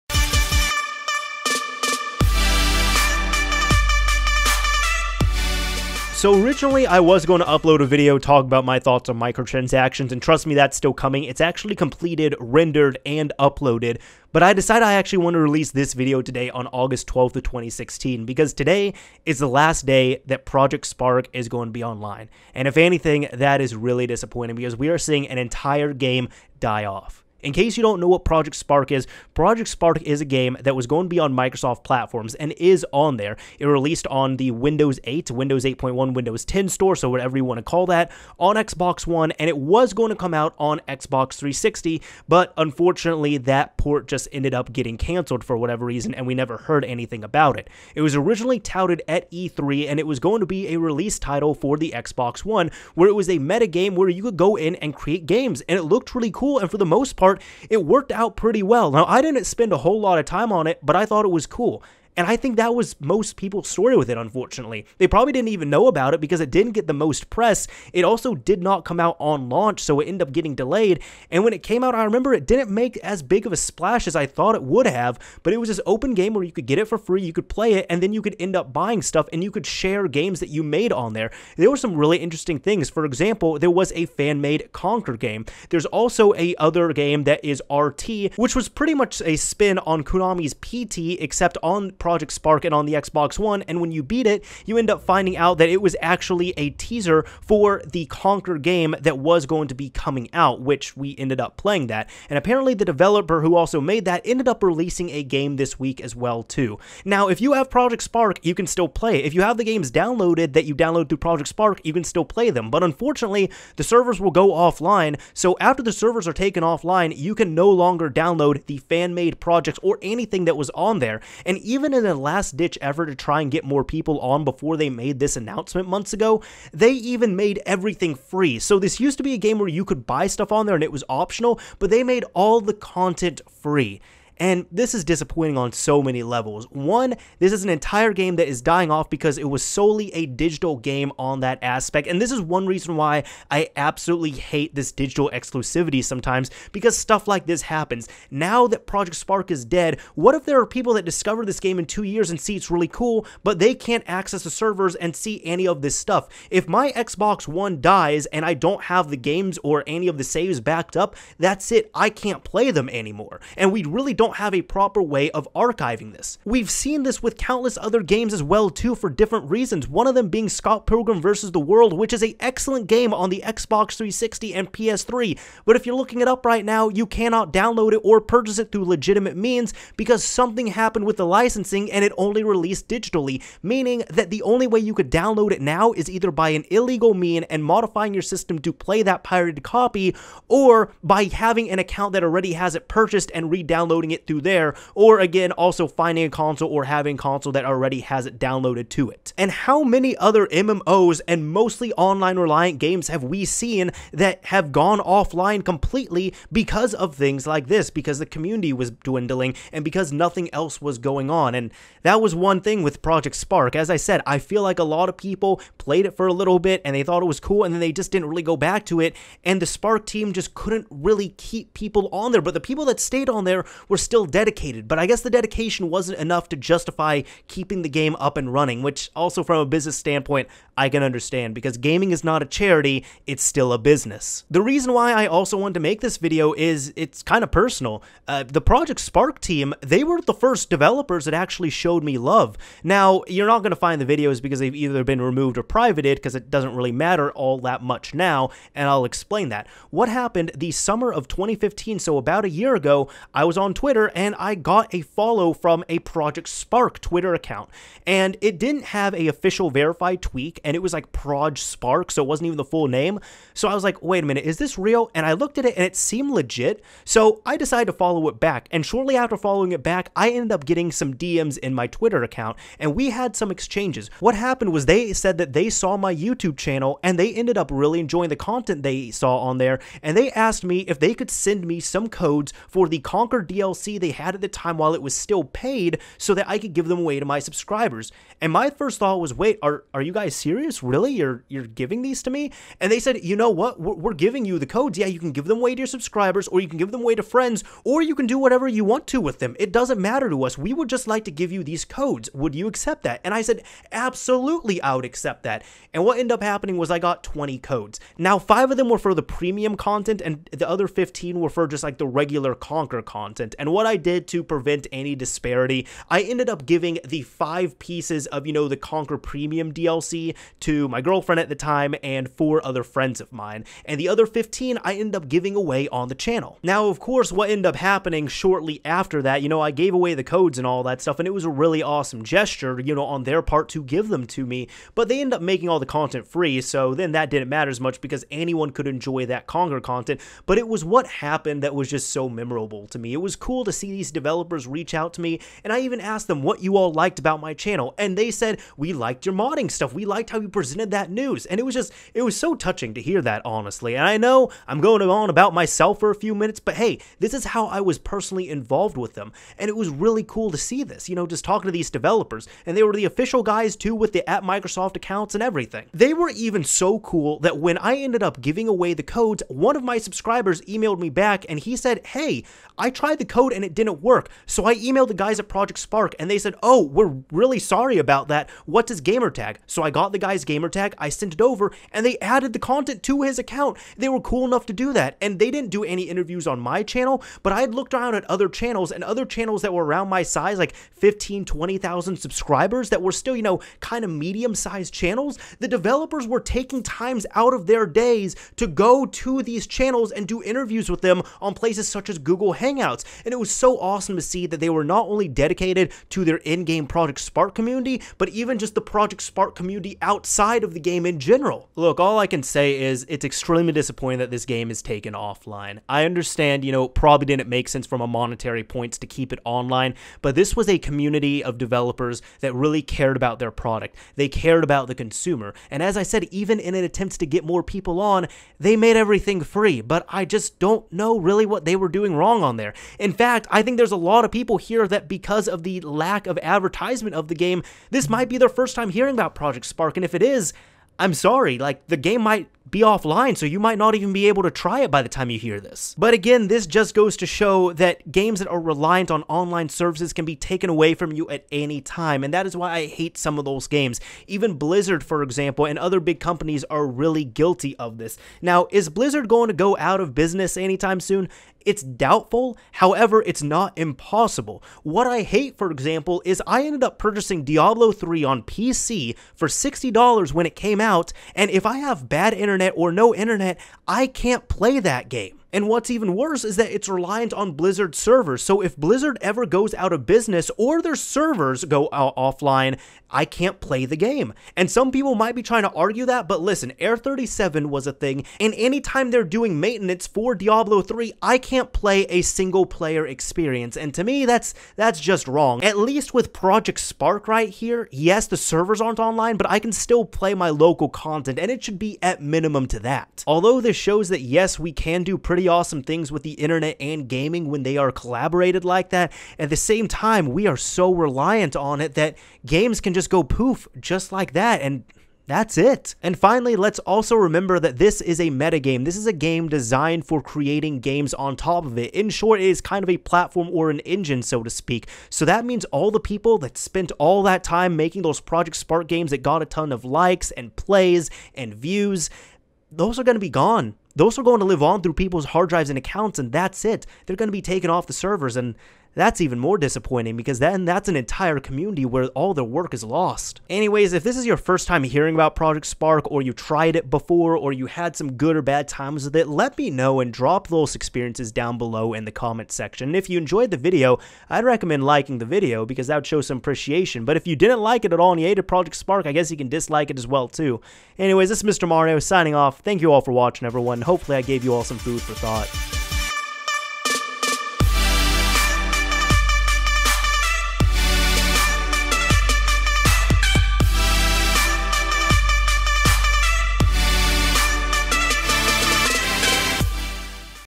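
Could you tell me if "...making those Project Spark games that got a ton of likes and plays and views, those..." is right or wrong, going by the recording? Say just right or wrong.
right.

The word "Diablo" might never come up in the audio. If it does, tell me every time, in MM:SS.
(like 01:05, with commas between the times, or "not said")
07:47, 08:10.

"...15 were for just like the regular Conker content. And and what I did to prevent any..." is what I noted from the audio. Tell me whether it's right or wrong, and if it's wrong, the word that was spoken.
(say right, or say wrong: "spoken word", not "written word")
right.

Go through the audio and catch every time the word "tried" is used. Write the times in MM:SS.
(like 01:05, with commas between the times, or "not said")
06:12, 09:06.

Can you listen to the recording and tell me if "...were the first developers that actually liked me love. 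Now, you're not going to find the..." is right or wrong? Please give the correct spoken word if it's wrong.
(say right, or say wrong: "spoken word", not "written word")
wrong: "showed", not "liked".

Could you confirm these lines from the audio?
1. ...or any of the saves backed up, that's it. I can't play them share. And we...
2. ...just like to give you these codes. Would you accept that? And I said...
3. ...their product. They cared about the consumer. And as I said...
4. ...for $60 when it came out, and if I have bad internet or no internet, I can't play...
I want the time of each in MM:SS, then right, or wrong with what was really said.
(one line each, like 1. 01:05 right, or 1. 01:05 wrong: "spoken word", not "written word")
1. 02:39 wrong: "anymore", not "share"
2. 05:00 right
3. 07:03 right
4. 07:49 right.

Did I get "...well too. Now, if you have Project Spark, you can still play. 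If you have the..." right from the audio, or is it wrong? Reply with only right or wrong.
right.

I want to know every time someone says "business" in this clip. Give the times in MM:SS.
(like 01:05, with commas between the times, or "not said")
03:49, 03:53, 07:40, 08:00.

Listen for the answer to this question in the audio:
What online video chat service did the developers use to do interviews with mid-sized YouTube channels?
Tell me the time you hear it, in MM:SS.
06:42.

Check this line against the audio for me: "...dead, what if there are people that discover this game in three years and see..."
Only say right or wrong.
wrong.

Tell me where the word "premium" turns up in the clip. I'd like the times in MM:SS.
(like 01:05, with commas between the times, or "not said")
05:09, 05:19.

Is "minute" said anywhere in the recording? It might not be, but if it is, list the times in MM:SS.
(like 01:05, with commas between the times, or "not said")
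04:24, 05:56.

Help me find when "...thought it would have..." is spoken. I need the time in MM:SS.
01:14.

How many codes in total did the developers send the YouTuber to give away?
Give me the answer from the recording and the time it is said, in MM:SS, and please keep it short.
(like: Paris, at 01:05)
20, at 05:07.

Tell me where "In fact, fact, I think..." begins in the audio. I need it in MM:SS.
07:12.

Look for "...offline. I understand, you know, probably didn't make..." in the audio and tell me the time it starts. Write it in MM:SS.
06:55.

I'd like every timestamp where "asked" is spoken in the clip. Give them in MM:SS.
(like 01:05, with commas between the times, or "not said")
04:40, 05:46.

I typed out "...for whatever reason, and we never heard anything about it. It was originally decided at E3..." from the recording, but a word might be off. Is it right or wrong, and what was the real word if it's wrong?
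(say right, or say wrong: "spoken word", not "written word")
wrong: "touted", not "decided".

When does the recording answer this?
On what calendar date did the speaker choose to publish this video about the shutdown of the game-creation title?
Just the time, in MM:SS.
00:16.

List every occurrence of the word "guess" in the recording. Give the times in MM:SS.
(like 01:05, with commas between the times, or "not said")
03:45, 09:19.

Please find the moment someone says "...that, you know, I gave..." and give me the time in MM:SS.
05:29.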